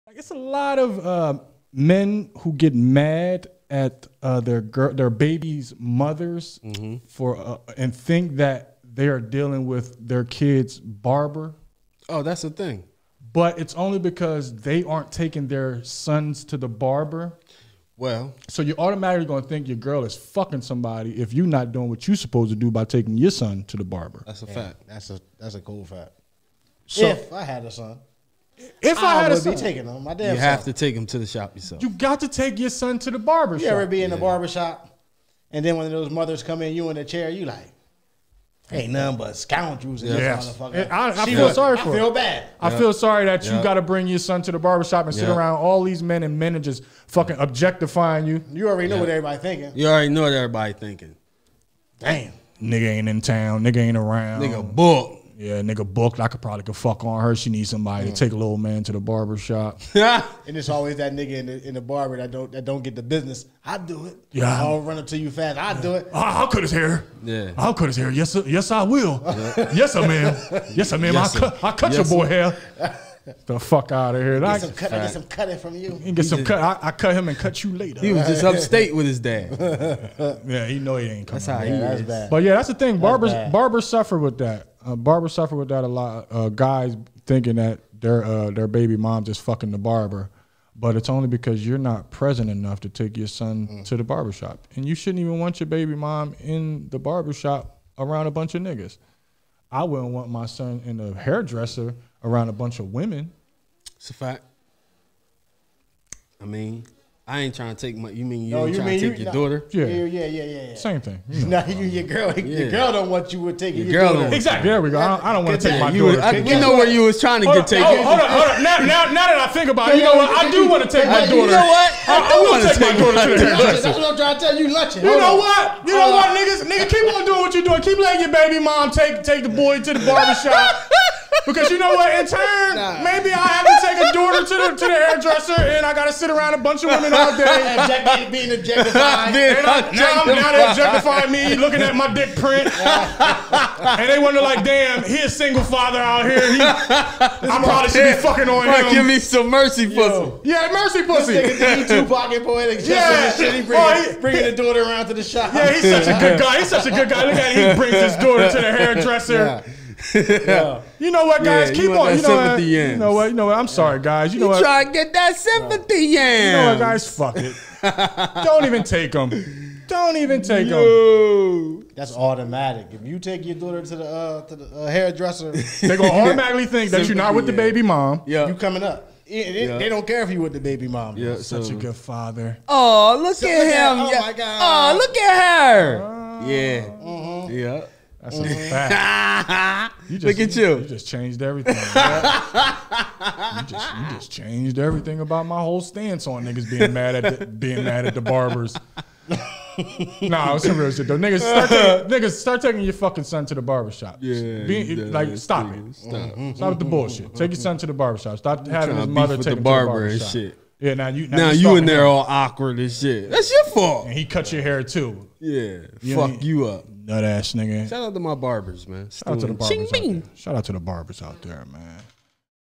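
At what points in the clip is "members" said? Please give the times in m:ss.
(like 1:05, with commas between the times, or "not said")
not said.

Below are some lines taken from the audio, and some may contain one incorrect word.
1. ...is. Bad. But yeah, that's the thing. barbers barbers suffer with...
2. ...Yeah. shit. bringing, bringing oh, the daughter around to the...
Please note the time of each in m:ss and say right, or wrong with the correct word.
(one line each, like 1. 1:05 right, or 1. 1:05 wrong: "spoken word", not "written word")
1. 1:21 right
2. 2:32 right.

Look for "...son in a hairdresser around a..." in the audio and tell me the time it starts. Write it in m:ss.
1:40.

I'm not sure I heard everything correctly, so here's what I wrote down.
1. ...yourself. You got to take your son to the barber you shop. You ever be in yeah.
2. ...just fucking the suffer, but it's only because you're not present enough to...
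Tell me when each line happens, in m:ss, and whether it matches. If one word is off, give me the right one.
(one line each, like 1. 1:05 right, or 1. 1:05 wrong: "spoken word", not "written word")
1. 0:31 right
2. 1:29 wrong: "barber", not "suffer".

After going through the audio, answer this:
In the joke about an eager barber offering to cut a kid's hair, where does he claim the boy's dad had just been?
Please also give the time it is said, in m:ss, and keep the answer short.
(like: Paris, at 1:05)
Upstate, at 1:18.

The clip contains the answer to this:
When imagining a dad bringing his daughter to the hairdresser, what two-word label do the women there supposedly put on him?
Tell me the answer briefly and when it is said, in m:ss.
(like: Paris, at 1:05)
Single father, at 2:25.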